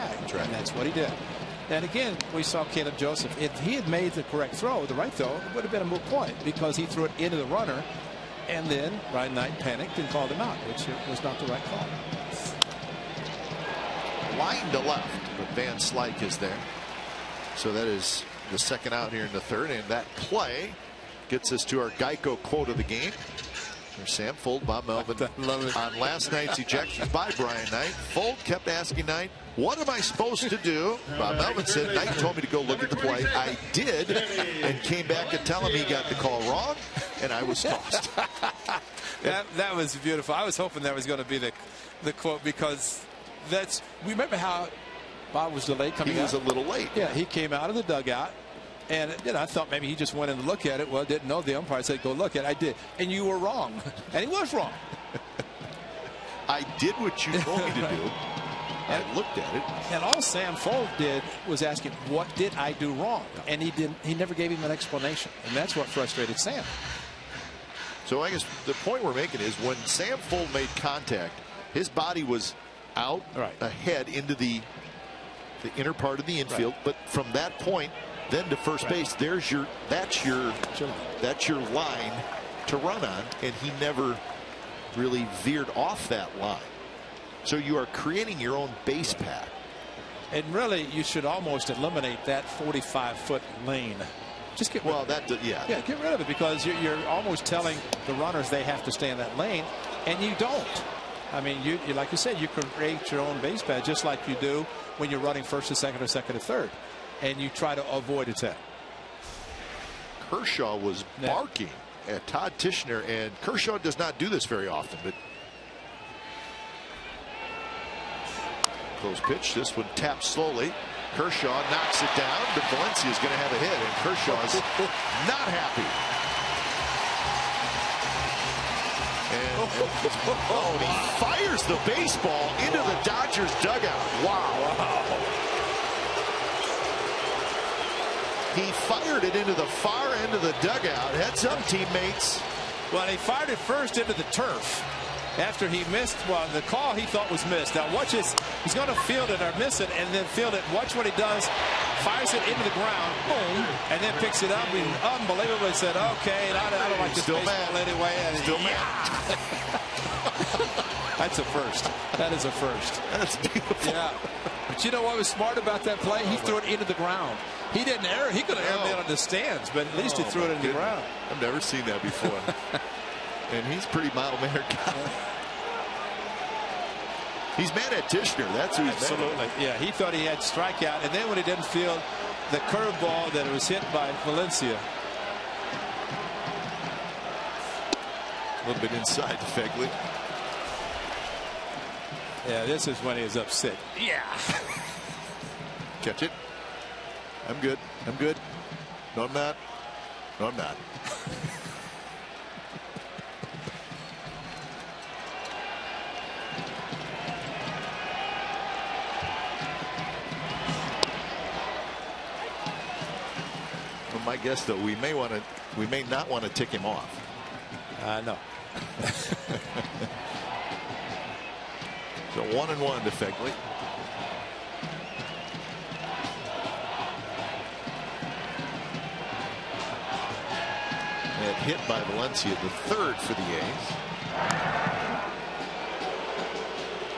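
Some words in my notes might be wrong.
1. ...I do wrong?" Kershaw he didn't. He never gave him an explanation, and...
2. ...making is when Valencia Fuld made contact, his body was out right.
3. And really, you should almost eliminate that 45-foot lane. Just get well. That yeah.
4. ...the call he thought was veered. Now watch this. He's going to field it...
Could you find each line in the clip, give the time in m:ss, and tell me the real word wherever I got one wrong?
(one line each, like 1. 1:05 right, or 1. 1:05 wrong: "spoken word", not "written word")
1. 1:02 wrong: "And", not "Kershaw"
2. 1:09 wrong: "Sam", not "Valencia"
3. 1:30 right
4. 2:26 wrong: "missed", not "veered".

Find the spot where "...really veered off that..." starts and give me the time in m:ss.
1:24.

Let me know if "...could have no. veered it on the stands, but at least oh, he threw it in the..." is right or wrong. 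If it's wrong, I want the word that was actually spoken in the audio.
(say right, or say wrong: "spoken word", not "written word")
wrong: "aired", not "veered".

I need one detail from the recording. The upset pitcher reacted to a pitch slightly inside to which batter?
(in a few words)
Phegley.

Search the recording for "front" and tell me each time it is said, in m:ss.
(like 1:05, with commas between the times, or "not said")
not said.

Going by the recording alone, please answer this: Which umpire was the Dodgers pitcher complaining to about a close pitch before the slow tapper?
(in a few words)
Todd Tichenor.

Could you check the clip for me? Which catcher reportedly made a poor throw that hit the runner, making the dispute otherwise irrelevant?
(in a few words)
Caleb Joseph.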